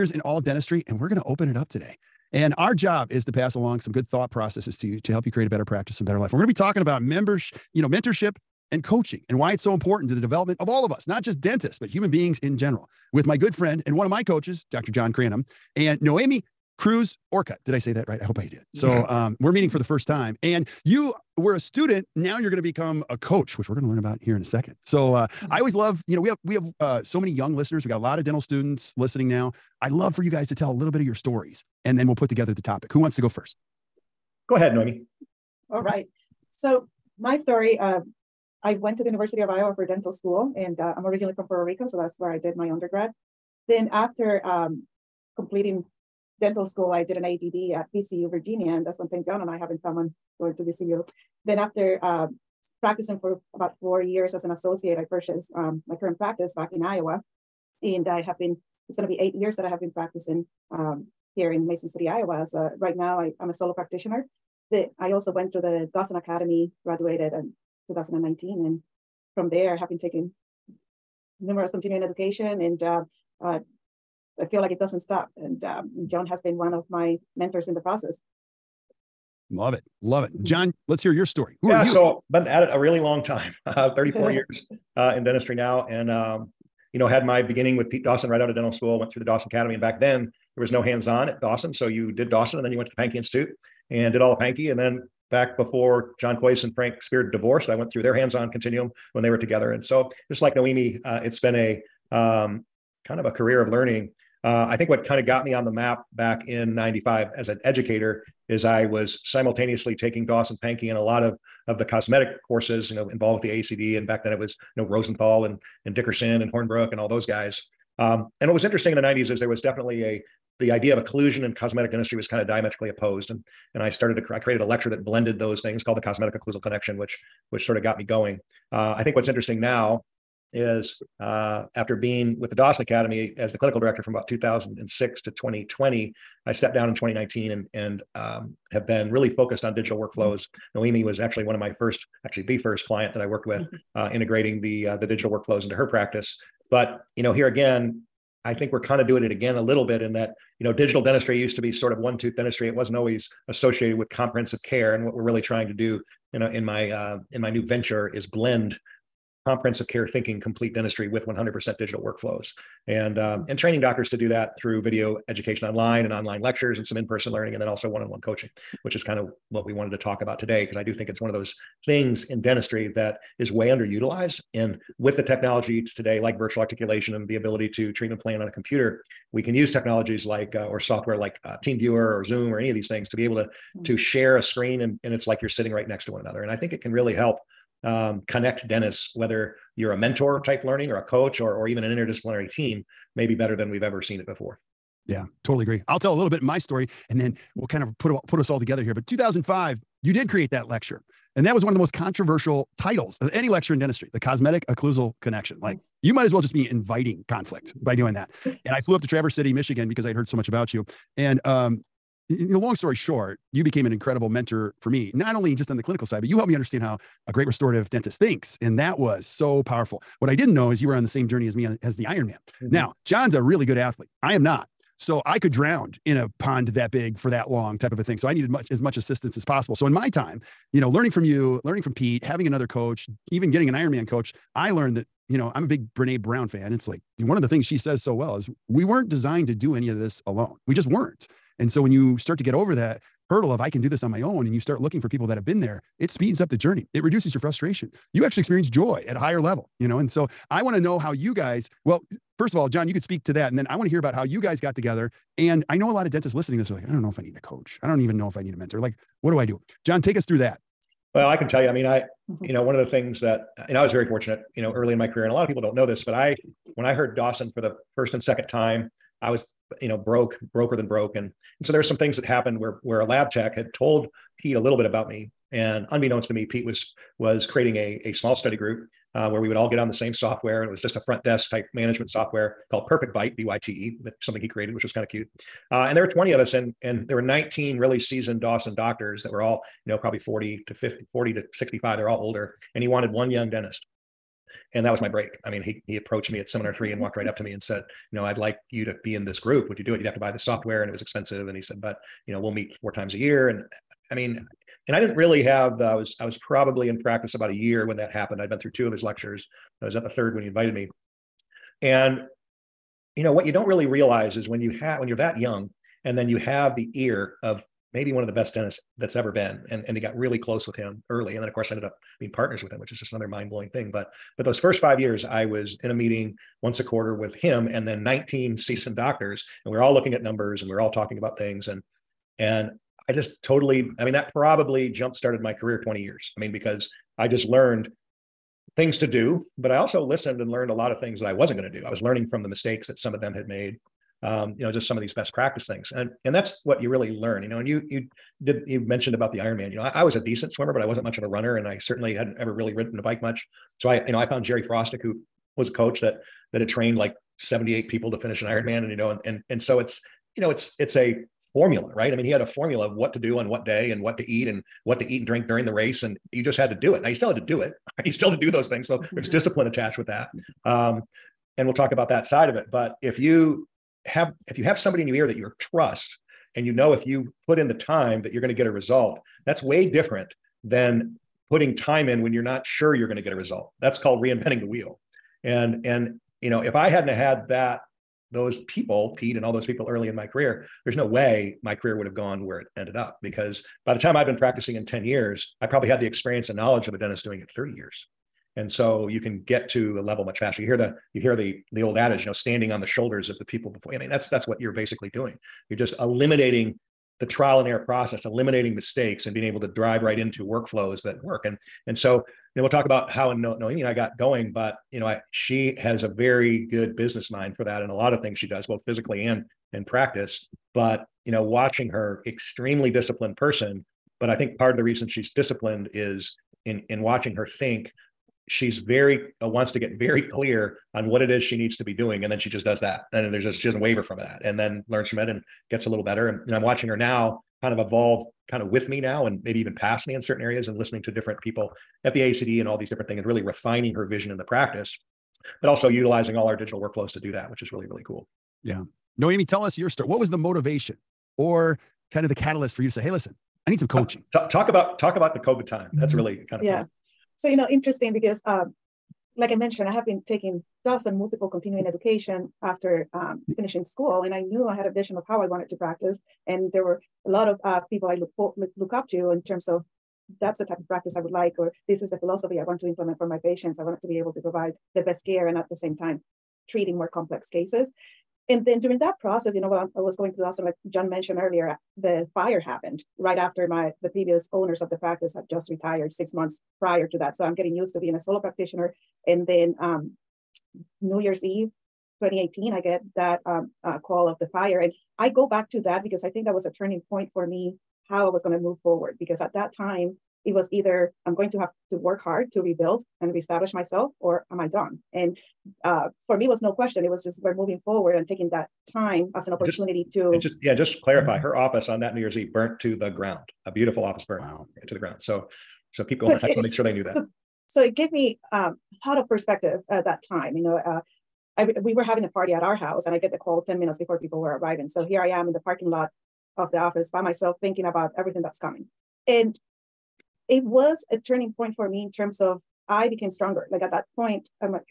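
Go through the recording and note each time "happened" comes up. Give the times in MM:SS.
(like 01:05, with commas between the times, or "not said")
04:32, 05:08, 08:02.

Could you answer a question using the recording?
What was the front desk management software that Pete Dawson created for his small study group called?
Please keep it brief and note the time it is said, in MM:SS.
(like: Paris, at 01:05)
Perfect Byte, at 04:42.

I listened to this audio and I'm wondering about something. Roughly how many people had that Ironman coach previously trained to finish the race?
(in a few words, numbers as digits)
78.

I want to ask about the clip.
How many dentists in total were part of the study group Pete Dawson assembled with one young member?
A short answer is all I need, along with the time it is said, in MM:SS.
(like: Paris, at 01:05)
20, at 04:45.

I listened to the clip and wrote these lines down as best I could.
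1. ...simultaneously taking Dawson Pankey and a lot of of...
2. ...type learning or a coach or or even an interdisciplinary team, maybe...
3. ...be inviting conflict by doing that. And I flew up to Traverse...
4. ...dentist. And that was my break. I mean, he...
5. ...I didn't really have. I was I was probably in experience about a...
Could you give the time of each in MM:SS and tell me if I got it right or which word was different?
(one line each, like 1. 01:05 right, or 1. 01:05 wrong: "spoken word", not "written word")
1. 01:49 right
2. 03:10 right
3. 03:26 right
4. 04:53 right
5. 05:04 wrong: "practice", not "experience".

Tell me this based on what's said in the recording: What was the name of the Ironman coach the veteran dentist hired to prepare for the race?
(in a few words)
Jerry Frostick.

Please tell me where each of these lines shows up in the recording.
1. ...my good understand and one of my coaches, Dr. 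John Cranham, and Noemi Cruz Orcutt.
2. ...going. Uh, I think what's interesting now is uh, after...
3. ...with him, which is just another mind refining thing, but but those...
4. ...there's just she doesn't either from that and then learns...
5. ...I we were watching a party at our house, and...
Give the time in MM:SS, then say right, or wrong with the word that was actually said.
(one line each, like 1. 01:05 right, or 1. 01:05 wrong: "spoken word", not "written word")
1. 00:13 wrong: "friend", not "understand"
2. 02:08 right
3. 05:22 wrong: "blowing", not "refining"
4. 07:13 wrong: "waver", not "either"
5. 08:41 wrong: "having", not "watching".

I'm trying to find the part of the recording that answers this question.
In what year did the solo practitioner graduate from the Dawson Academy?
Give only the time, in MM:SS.
01:06.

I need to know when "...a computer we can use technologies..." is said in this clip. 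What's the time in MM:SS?
02:58.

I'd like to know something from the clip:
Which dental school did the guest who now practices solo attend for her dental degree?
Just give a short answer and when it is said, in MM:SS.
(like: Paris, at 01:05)
University of Iowa, at 00:39.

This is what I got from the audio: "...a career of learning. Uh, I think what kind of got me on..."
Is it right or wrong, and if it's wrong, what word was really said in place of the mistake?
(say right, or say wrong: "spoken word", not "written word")
right.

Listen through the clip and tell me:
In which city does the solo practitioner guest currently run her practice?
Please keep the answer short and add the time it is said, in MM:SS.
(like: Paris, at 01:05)
Mason City, Iowa, at 01:01.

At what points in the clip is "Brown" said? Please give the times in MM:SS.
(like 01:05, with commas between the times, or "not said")
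03:56.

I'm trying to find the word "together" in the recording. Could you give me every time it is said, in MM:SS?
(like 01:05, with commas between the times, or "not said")
00:32, 01:39, 03:18, 04:14.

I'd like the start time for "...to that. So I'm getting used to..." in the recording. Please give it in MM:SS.
08:07.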